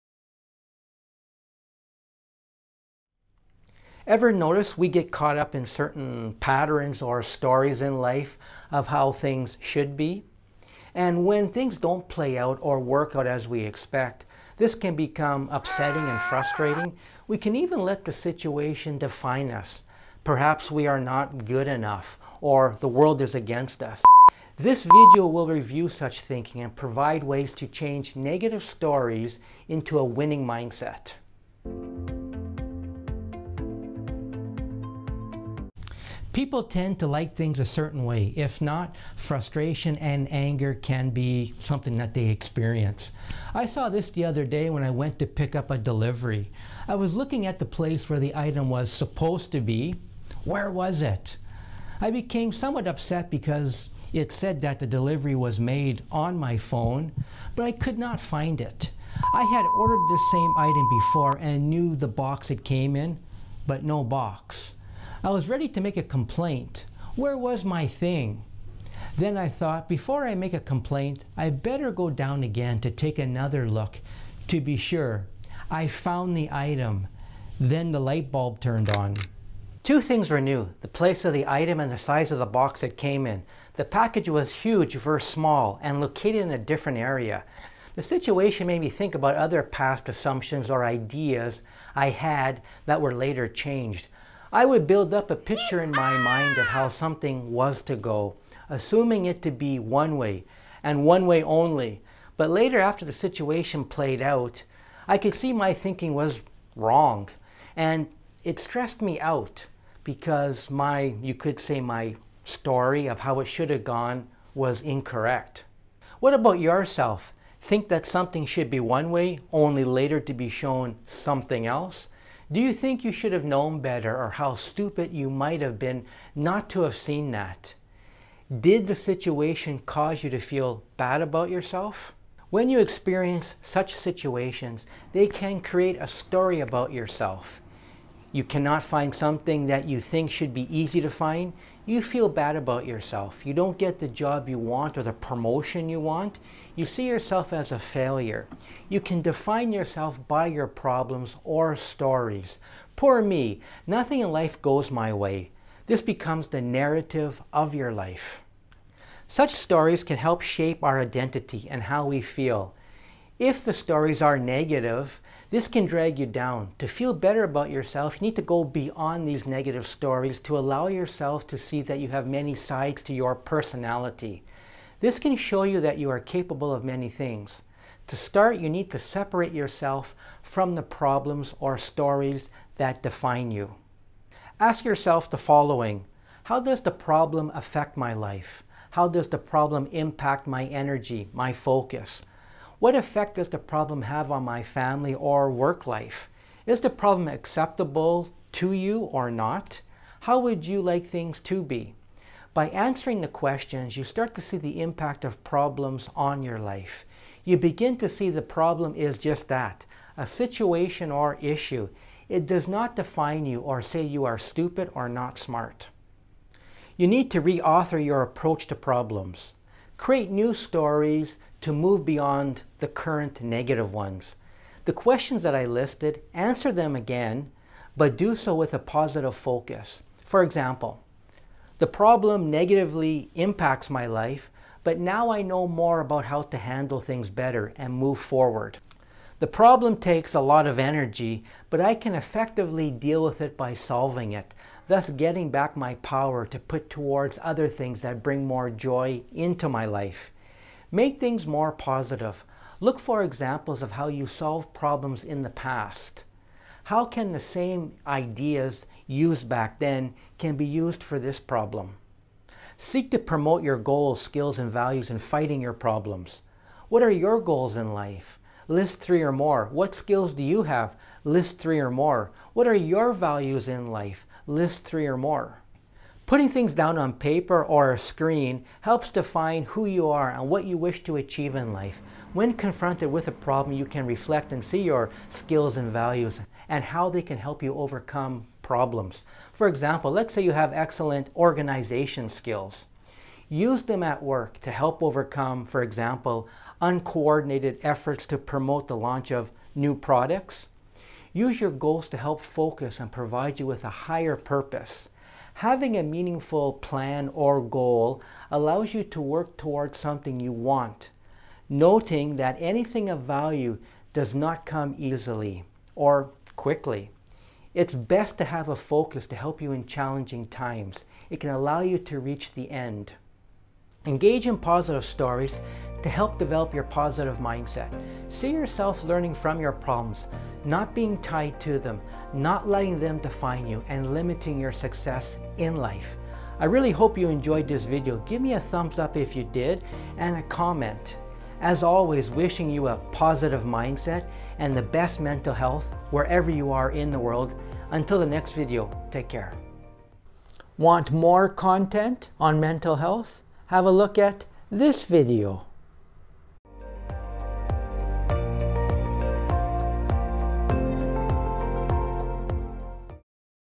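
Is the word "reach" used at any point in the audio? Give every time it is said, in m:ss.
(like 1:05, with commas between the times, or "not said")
5:22.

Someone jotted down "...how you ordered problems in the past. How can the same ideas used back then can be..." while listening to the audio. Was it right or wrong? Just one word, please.
wrong.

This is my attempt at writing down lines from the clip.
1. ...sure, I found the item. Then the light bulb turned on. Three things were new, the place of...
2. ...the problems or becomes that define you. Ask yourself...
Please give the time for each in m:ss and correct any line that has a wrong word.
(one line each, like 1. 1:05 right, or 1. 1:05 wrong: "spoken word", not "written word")
1. 1:14 wrong: "Two", not "Three"
2. 3:00 wrong: "stories", not "becomes".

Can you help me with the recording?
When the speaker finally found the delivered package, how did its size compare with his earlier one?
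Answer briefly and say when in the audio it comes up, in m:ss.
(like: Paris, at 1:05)
Huge, at 1:24.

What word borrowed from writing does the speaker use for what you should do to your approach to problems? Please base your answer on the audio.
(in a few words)
Reauthor.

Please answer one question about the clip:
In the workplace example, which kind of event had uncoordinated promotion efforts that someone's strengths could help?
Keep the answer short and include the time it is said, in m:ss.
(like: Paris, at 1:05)
Launch of new products, at 4:58.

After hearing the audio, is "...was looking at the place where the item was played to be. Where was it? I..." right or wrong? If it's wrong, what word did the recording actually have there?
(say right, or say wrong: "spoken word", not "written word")
wrong: "supposed", not "played".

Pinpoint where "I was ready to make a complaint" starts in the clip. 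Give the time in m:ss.
1:05.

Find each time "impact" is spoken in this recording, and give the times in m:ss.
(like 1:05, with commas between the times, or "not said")
3:09, 3:24, 3:53.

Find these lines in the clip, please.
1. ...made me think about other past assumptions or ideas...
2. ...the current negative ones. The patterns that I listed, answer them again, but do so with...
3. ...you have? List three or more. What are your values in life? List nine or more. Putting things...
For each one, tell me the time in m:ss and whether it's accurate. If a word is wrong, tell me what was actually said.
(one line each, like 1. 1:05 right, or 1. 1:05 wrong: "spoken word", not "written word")
1. 1:28 right
2. 3:42 wrong: "questions", not "patterns"
3. 4:30 wrong: "three", not "nine".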